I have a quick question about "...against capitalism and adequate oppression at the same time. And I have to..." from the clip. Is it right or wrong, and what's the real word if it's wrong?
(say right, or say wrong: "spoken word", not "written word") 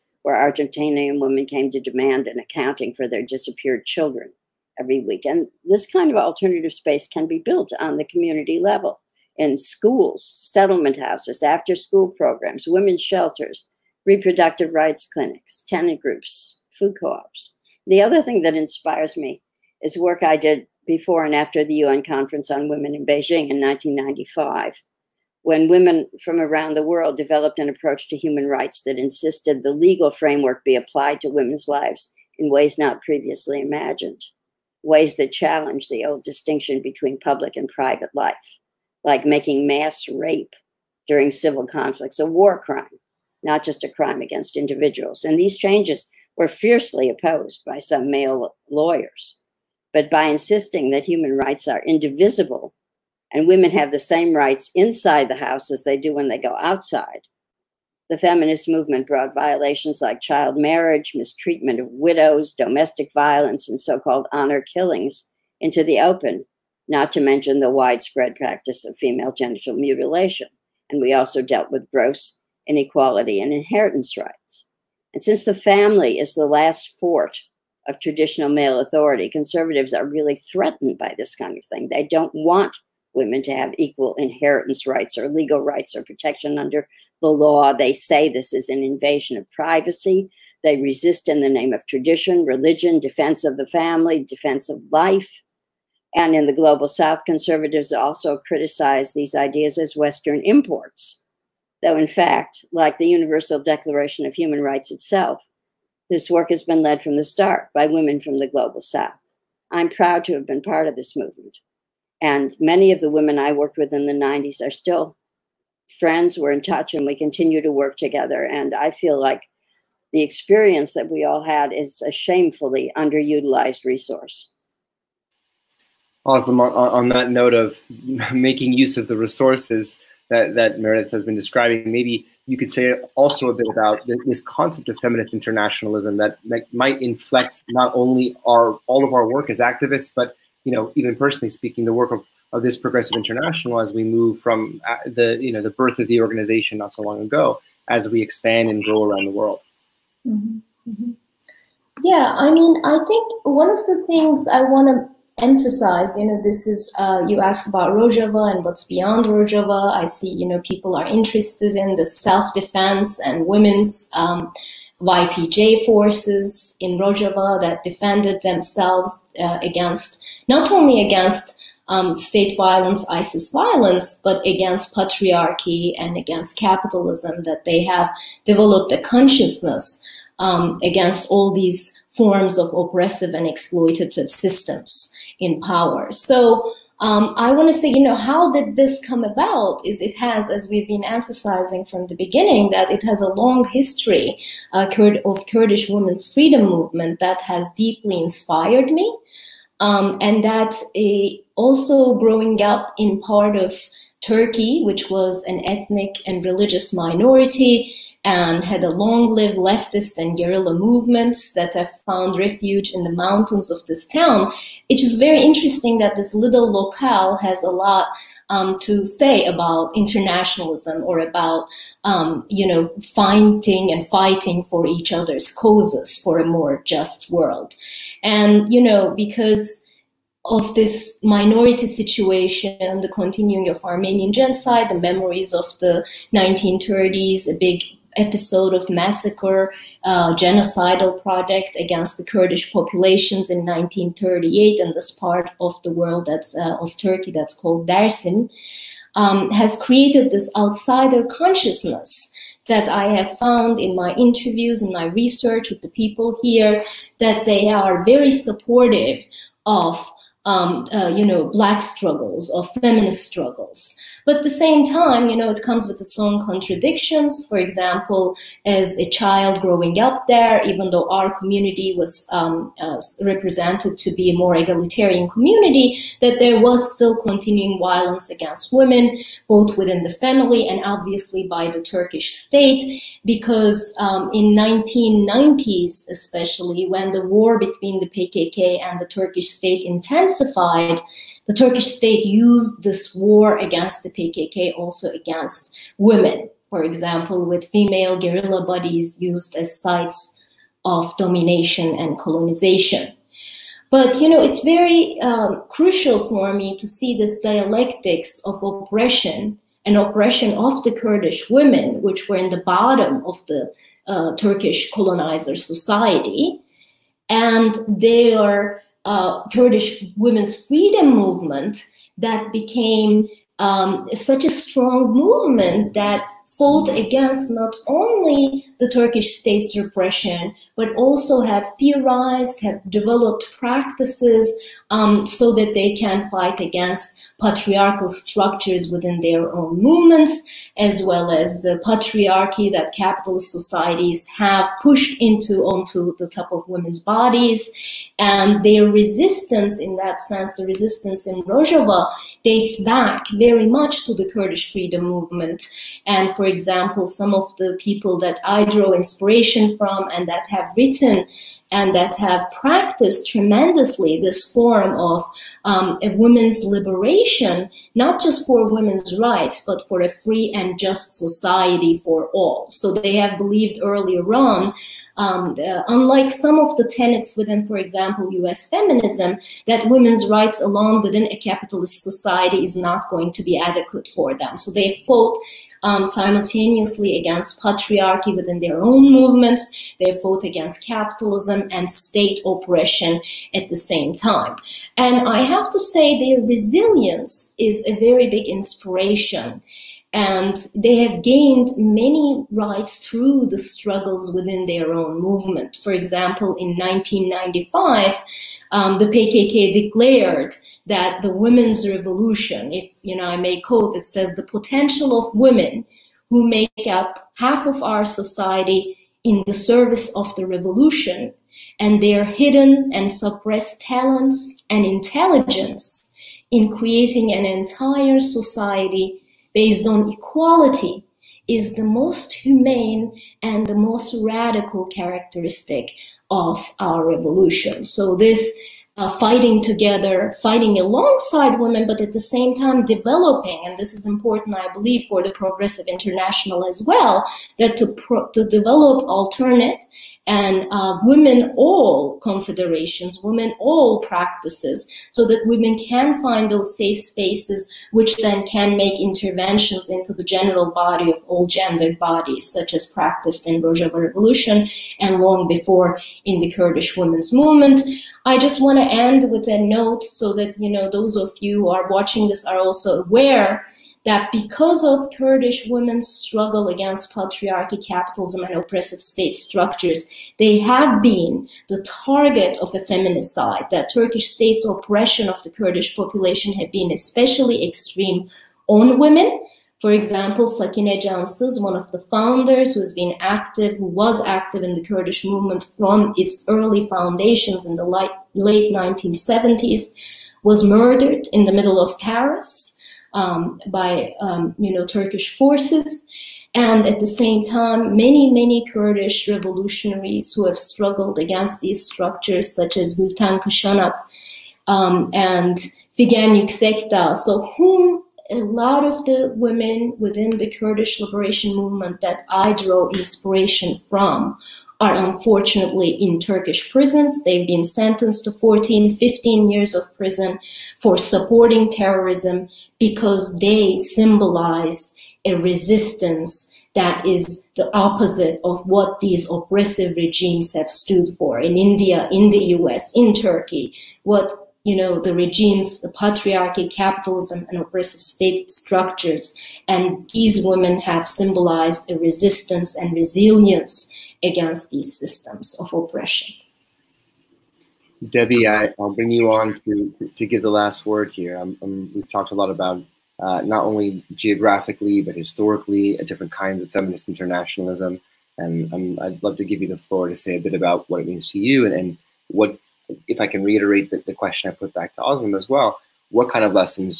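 wrong: "state", not "adequate".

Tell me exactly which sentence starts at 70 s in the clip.
And we also dealt with gross inequality in inheritance rights.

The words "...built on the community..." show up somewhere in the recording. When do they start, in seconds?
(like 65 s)
7 s.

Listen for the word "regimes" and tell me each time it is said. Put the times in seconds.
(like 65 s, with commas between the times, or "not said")
539 s, 545 s.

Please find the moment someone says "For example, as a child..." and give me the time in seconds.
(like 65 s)
267 s.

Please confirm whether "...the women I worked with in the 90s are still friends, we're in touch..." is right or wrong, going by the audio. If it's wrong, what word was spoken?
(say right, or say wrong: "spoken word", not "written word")
right.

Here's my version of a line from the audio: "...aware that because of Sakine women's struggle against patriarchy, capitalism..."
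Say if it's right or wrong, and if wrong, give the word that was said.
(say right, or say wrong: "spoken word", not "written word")
wrong: "Kurdish", not "Sakine".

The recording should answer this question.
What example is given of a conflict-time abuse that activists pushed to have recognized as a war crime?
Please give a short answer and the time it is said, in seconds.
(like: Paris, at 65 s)
Mass rape, at 39 s.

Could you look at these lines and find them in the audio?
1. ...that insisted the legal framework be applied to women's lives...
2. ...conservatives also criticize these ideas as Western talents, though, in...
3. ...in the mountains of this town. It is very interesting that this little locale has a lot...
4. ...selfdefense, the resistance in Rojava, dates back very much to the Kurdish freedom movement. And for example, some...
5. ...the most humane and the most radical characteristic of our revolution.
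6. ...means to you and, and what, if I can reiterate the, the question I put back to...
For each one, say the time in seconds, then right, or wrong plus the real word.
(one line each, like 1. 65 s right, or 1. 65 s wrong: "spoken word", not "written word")
1. 28 s right
2. 97 s wrong: "imports", not "talents"
3. 212 s right
4. 350 s wrong: "sense", not "selfdefense"
5. 431 s right
6. 571 s right.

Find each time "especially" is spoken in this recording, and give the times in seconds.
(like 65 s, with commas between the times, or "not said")
286 s, 486 s.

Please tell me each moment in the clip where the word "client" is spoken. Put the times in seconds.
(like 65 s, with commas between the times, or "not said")
not said.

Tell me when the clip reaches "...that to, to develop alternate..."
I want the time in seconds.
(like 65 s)
447 s.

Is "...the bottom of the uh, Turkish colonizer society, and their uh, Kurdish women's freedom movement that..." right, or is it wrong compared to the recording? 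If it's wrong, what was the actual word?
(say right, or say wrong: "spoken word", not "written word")
right.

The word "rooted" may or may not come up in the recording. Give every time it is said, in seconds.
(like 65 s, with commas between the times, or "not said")
not said.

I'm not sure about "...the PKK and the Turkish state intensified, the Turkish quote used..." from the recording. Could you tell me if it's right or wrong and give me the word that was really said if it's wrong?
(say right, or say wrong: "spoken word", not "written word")
wrong: "state", not "quote".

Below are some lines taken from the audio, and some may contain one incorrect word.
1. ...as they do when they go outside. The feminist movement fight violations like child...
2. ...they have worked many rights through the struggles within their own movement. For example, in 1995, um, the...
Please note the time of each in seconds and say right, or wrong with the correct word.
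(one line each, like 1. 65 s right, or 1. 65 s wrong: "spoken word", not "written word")
1. 55 s wrong: "brought", not "fight"
2. 400 s wrong: "gained", not "worked".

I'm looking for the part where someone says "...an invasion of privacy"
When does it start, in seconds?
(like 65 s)
88 s.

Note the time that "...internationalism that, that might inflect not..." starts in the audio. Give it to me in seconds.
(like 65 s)
135 s.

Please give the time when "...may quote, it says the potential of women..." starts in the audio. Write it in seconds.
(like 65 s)
413 s.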